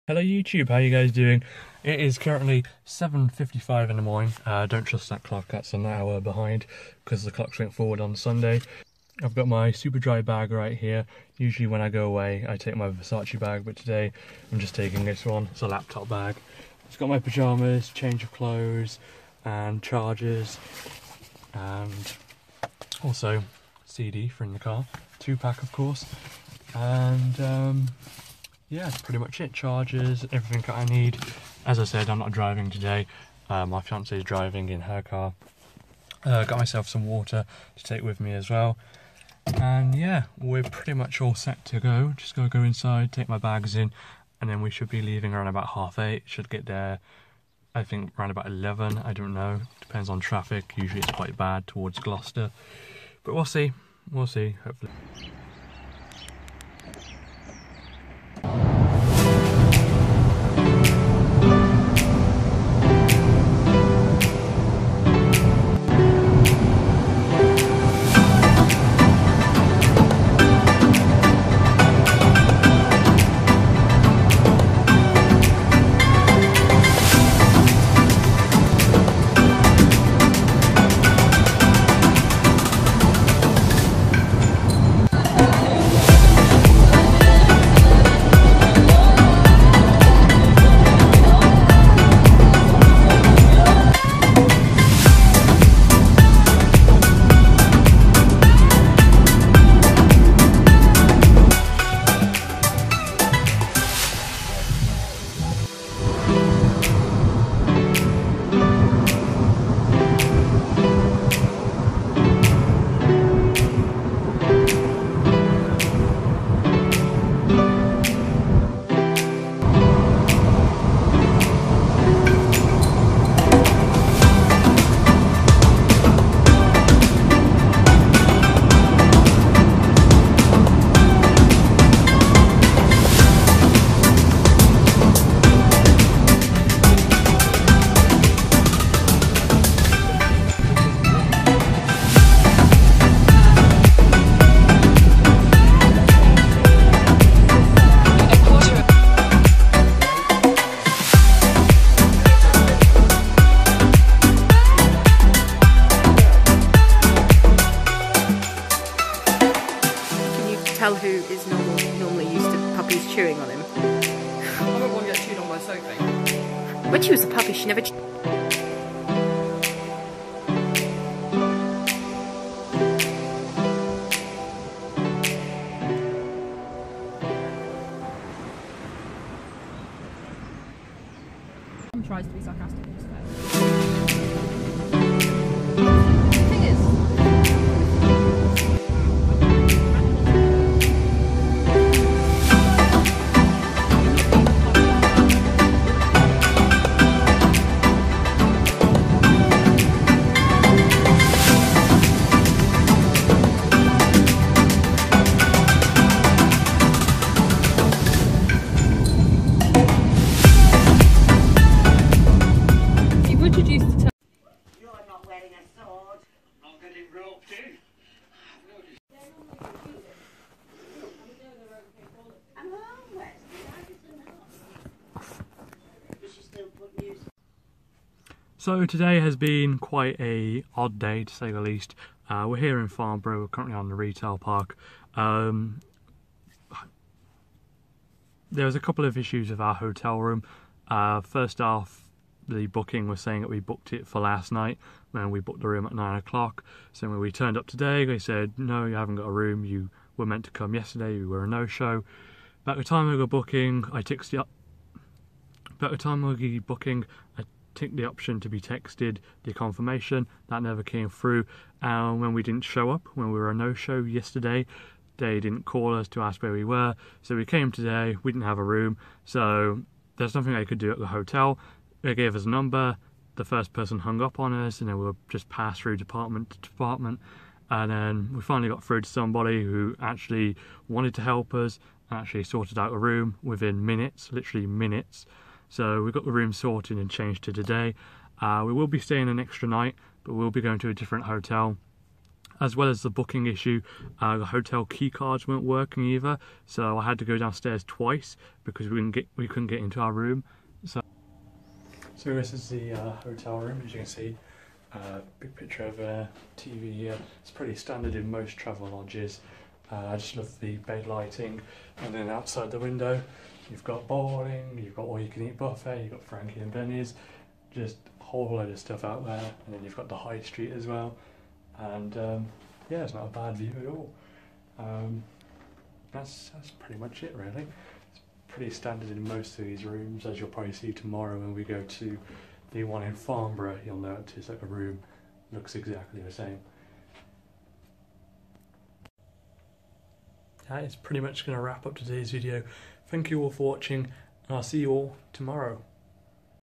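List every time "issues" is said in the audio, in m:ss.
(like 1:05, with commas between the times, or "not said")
3:59, 4:53.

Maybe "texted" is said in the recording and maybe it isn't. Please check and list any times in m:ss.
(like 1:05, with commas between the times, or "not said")
4:14, 4:18.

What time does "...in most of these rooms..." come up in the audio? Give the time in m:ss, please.
5:29.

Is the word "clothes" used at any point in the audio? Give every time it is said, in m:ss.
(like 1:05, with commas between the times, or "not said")
0:18.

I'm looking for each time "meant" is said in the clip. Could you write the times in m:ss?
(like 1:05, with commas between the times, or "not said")
4:10.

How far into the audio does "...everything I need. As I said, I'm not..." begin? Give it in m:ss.
0:30.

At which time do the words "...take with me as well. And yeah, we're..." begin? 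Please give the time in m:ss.
0:37.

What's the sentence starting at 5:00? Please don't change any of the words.
So, so this is the uh, hotel room, as you can see.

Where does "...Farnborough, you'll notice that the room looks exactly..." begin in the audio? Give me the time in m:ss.
5:33.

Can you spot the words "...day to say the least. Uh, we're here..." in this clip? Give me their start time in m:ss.
3:50.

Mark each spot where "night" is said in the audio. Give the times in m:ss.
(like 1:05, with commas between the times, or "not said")
4:04, 4:49.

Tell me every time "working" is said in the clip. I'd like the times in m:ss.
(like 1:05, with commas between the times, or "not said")
4:55.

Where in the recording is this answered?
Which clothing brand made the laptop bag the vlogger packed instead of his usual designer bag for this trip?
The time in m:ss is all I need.
0:09.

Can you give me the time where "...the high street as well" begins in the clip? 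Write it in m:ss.
5:20.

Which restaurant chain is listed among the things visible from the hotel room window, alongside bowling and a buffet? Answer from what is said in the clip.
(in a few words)
Frankie and Benny's.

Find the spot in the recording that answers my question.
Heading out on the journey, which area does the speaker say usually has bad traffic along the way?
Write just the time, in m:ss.
0:51.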